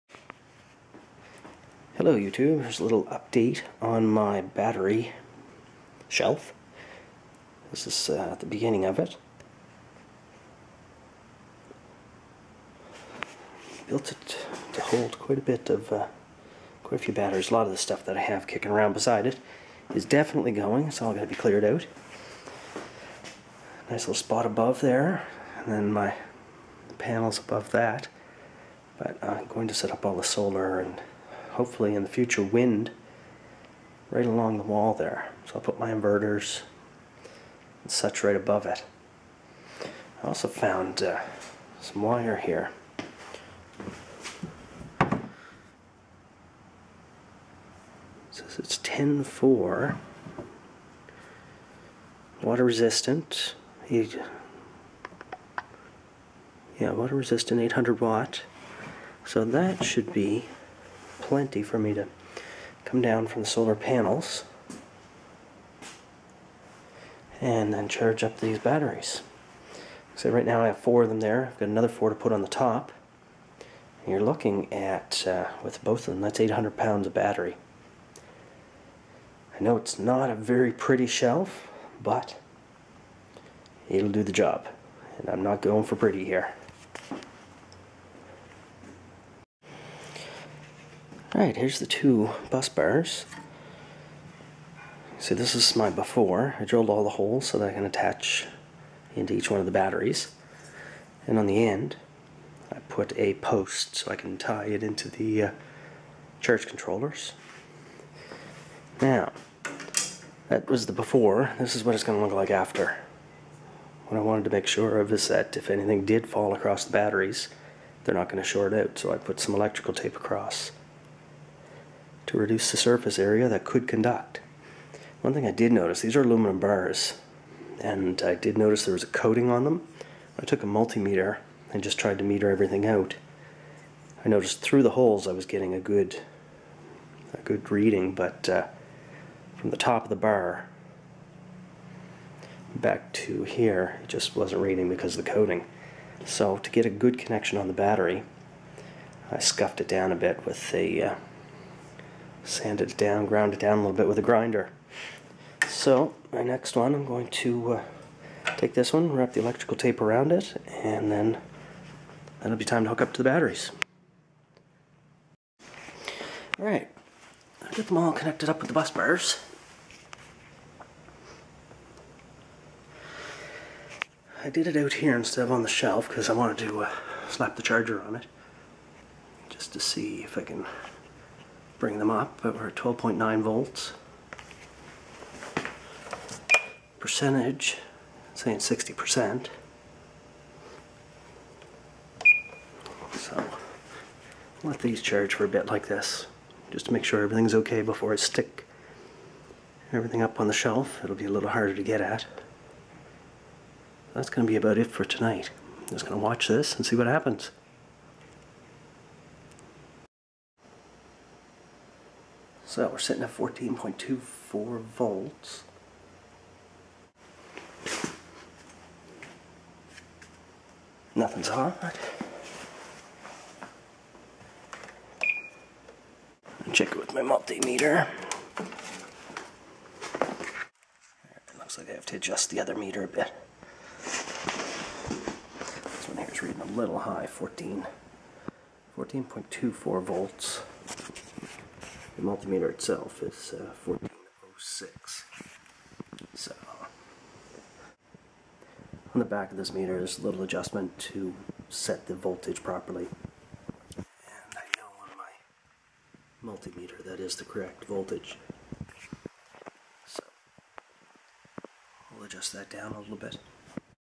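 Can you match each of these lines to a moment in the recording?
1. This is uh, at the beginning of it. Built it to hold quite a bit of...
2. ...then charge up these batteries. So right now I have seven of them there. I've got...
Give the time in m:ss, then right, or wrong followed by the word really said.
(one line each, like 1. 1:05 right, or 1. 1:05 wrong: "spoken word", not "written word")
1. 0:07 right
2. 1:07 wrong: "four", not "seven".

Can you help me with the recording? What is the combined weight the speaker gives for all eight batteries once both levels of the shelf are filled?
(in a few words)
800 pounds.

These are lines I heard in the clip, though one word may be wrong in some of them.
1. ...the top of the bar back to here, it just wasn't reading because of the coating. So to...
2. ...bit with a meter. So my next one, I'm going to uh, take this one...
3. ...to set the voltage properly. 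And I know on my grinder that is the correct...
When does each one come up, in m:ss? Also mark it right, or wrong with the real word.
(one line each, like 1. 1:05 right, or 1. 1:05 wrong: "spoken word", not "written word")
1. 2:19 right
2. 2:33 wrong: "grinder", not "meter"
3. 4:10 wrong: "multimeter", not "grinder".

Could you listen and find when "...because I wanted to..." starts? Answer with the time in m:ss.
2:56.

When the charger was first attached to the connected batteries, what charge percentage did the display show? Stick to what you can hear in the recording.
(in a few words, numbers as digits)
60%.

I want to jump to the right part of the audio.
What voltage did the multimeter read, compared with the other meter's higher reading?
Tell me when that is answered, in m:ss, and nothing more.
4:03.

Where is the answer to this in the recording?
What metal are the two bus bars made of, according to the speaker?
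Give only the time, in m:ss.
2:06.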